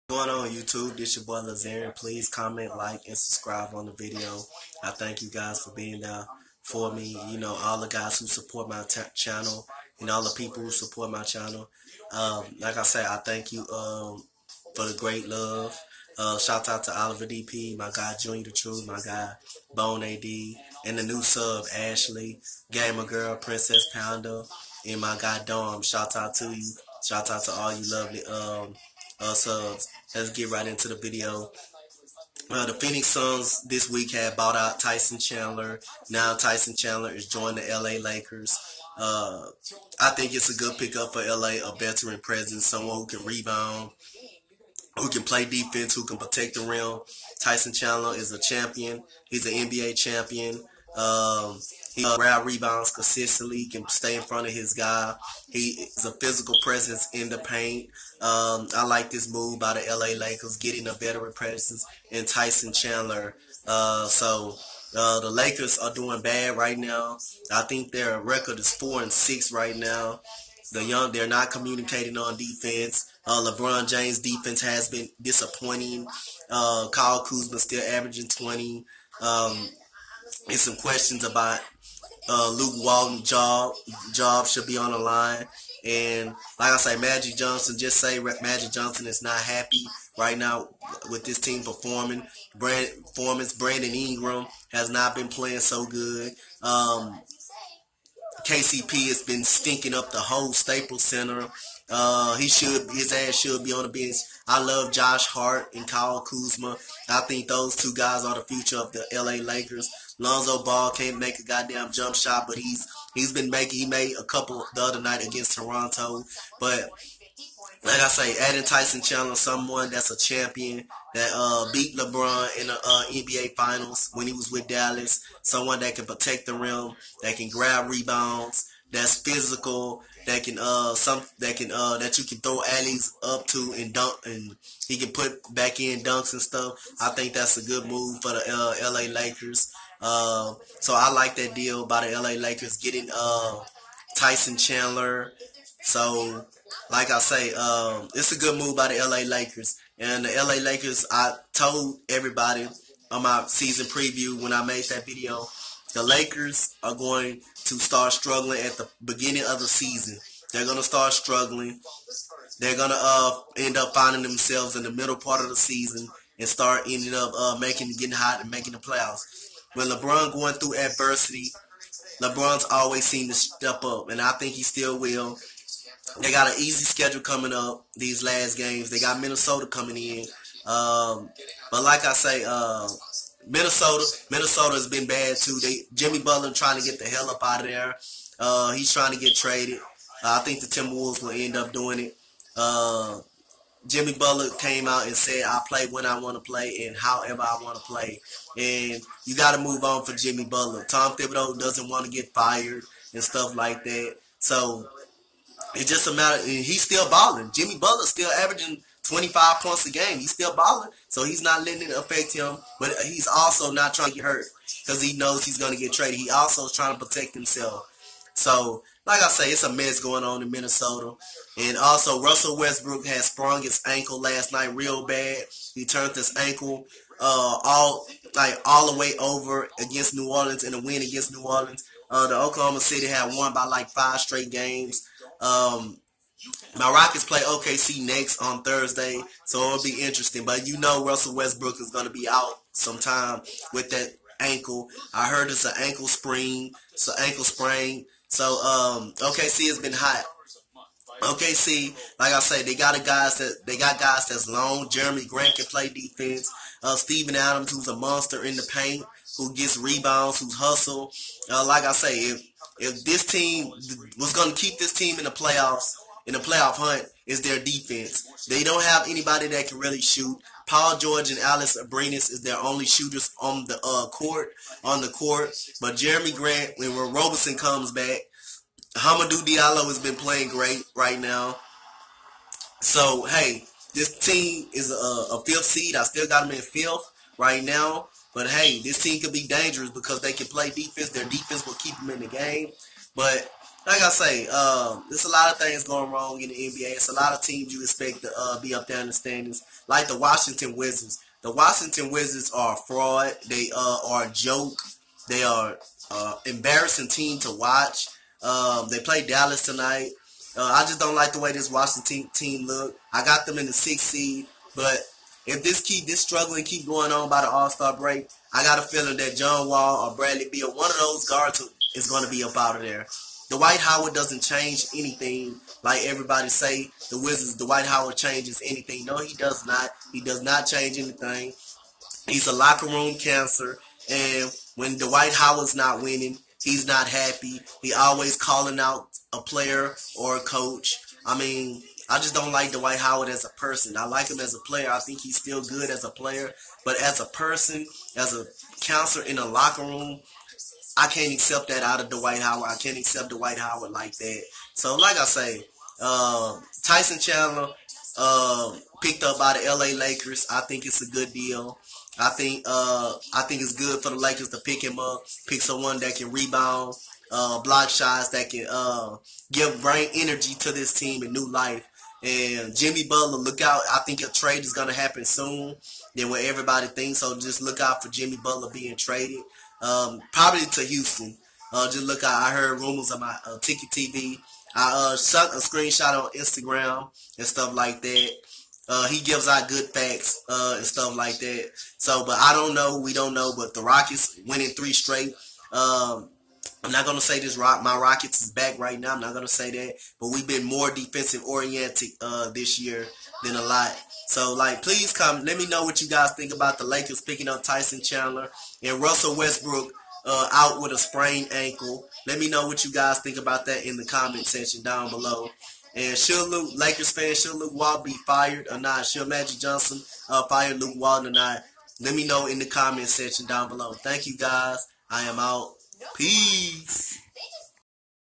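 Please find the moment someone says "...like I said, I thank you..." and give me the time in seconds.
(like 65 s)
12 s.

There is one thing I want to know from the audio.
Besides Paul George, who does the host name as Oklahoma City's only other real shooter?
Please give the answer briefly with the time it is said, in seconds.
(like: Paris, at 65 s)
Alex Abrines, at 271 s.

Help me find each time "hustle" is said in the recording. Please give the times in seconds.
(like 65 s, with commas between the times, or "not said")
260 s.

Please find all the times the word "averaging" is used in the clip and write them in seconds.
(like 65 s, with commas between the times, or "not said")
77 s, 208 s.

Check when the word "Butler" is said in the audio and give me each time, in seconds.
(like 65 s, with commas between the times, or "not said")
186 s, 194 s, 200 s, 207 s, 373 s, 378 s.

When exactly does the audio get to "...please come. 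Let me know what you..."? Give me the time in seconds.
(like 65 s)
404 s.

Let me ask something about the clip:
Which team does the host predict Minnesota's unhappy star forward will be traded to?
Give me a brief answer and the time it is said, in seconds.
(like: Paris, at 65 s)
Houston, at 380 s.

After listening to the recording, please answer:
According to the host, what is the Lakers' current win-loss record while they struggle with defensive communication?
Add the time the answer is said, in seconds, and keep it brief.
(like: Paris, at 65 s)
4 and 6, at 68 s.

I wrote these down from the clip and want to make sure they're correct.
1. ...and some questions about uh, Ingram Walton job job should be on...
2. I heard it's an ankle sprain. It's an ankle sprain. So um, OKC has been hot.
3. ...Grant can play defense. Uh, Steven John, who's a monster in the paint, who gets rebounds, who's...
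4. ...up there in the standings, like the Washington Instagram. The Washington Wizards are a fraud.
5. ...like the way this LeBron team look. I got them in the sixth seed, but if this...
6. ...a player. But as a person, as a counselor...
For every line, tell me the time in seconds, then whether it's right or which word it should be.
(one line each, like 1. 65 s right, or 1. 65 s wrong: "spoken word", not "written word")
1. 80 s wrong: "Luke", not "Ingram"
2. 245 s right
3. 255 s wrong: "Adams", not "John"
4. 298 s wrong: "Wizards", not "Instagram"
5. 311 s wrong: "Washington", not "LeBron"
6. 346 s right.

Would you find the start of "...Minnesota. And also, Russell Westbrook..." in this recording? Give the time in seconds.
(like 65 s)
220 s.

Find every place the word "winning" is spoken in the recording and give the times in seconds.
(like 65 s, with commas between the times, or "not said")
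336 s, 394 s.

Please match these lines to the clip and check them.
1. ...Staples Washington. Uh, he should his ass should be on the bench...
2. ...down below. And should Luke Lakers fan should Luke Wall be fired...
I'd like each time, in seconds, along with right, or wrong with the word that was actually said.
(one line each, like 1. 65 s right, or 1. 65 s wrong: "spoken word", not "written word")
1. 100 s wrong: "Center", not "Washington"
2. 414 s right.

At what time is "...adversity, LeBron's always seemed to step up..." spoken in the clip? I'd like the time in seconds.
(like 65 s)
170 s.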